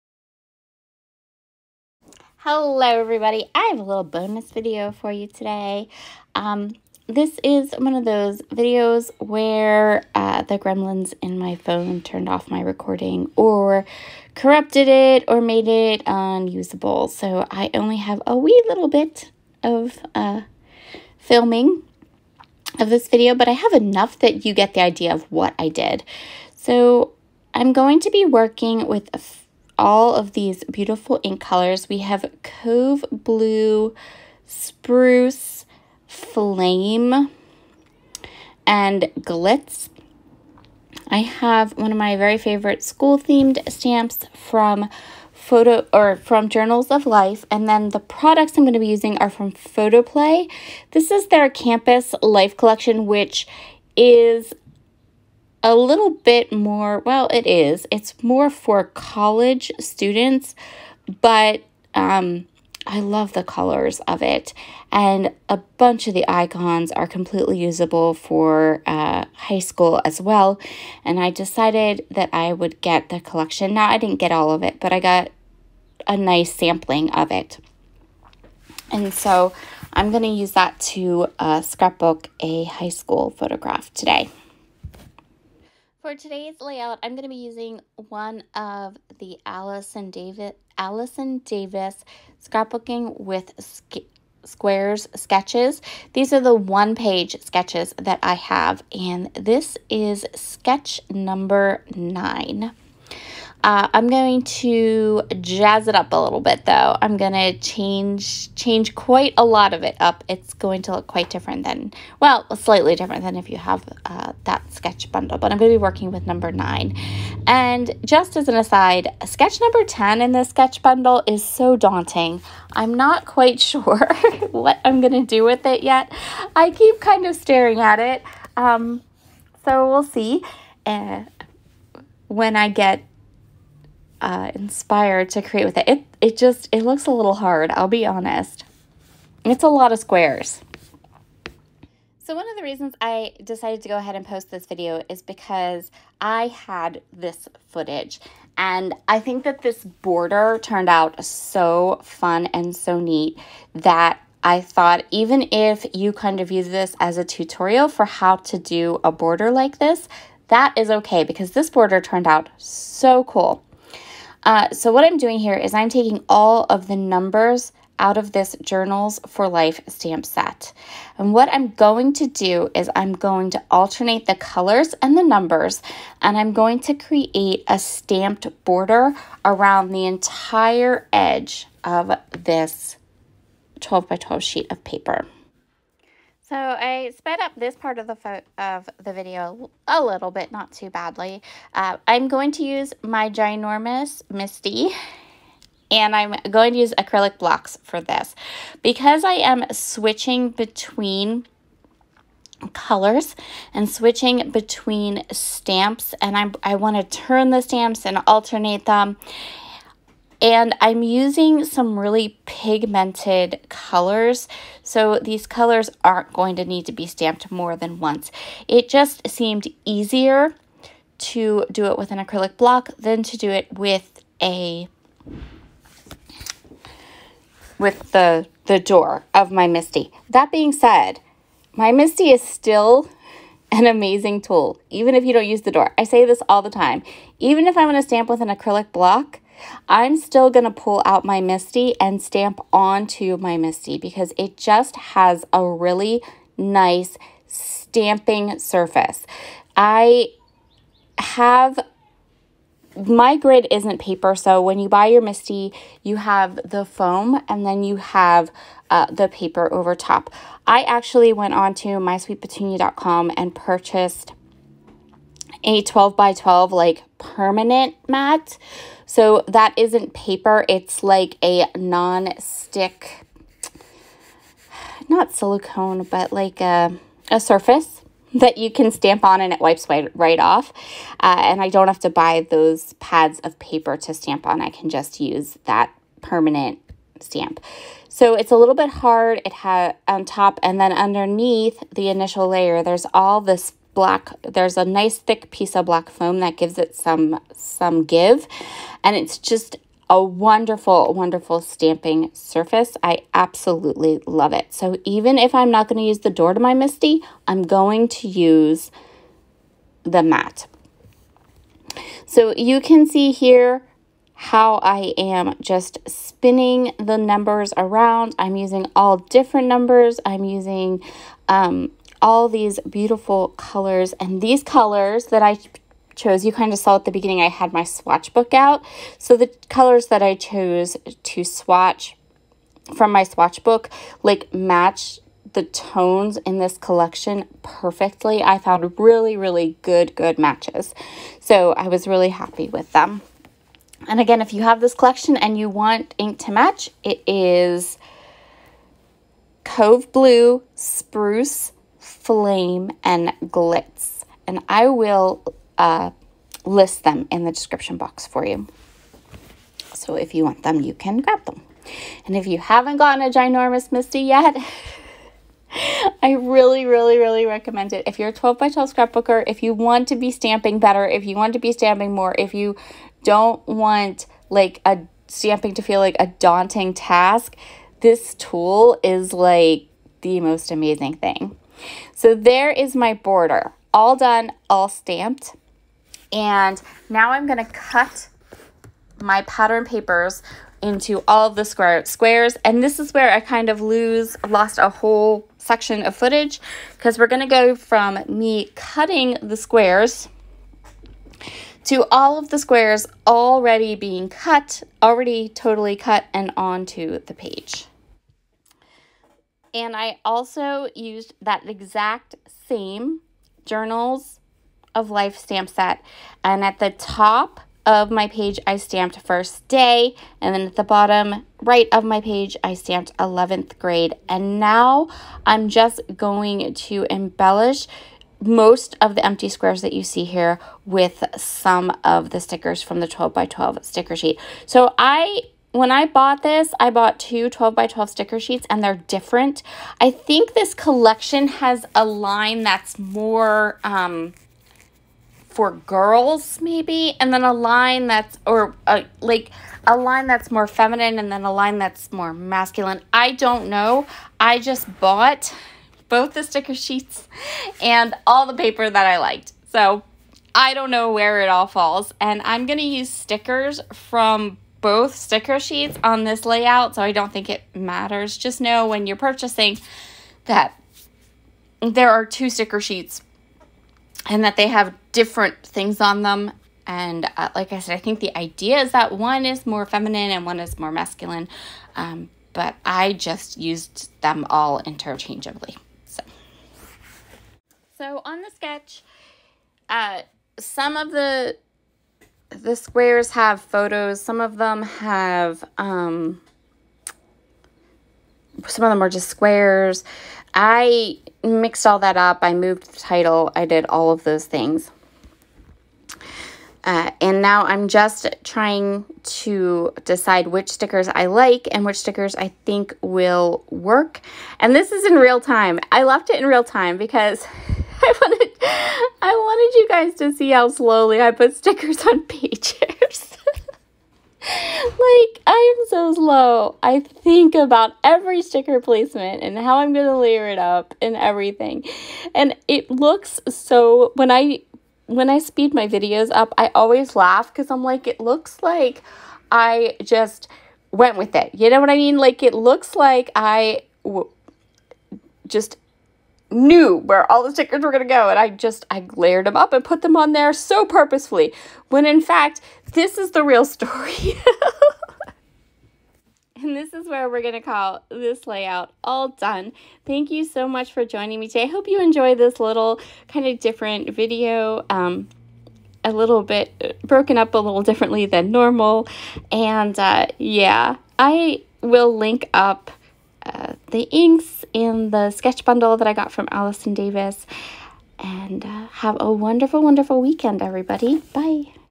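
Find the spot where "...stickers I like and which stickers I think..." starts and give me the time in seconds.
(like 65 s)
510 s.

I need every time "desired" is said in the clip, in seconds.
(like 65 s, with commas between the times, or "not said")
not said.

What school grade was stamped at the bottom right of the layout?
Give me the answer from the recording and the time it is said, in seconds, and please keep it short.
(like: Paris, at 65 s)
11th grade, at 423 s.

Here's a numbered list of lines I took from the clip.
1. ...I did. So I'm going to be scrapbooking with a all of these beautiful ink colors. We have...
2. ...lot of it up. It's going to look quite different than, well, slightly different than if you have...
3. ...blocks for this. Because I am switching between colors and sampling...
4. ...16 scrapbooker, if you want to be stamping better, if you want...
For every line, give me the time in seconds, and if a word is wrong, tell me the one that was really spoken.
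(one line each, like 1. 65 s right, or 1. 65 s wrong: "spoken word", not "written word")
1. 25 s wrong: "working", not "scrapbooking"
2. 109 s right
3. 197 s wrong: "switching", not "sampling"
4. 368 s wrong: "12", not "16".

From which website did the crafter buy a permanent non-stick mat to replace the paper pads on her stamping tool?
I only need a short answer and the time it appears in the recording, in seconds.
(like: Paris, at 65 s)
mysweetpetunia.com, at 261 s.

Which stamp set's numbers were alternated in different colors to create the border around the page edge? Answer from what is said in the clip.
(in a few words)
Journals for Life.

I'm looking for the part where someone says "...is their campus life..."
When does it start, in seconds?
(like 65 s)
51 s.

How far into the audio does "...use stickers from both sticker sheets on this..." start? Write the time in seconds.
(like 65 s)
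462 s.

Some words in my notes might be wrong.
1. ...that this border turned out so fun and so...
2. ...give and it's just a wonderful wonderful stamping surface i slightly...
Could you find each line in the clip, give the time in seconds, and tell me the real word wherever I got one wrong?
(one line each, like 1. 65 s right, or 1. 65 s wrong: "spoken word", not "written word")
1. 149 s right
2. 298 s wrong: "absolutely", not "slightly".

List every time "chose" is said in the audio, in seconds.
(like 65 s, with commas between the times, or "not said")
326 s, 330 s.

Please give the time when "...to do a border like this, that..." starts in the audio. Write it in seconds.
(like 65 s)
158 s.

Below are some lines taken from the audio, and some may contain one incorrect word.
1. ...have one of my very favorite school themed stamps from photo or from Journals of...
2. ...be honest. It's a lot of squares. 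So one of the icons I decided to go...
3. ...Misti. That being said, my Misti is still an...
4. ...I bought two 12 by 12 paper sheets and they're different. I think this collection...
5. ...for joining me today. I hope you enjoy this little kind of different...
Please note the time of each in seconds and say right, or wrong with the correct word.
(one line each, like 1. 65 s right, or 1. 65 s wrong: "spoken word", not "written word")
1. 41 s right
2. 137 s wrong: "reasons", not "icons"
3. 229 s right
4. 436 s wrong: "sticker", not "paper"
5. 560 s right.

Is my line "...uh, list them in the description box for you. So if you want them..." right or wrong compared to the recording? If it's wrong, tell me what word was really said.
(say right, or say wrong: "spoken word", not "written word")
right.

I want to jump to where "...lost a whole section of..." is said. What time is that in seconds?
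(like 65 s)
394 s.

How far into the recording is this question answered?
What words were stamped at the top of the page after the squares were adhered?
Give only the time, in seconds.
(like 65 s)
419 s.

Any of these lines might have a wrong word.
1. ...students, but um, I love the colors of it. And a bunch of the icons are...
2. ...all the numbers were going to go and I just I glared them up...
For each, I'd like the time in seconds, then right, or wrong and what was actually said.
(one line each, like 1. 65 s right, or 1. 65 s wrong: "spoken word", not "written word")
1. 59 s right
2. 547 s wrong: "stickers", not "numbers".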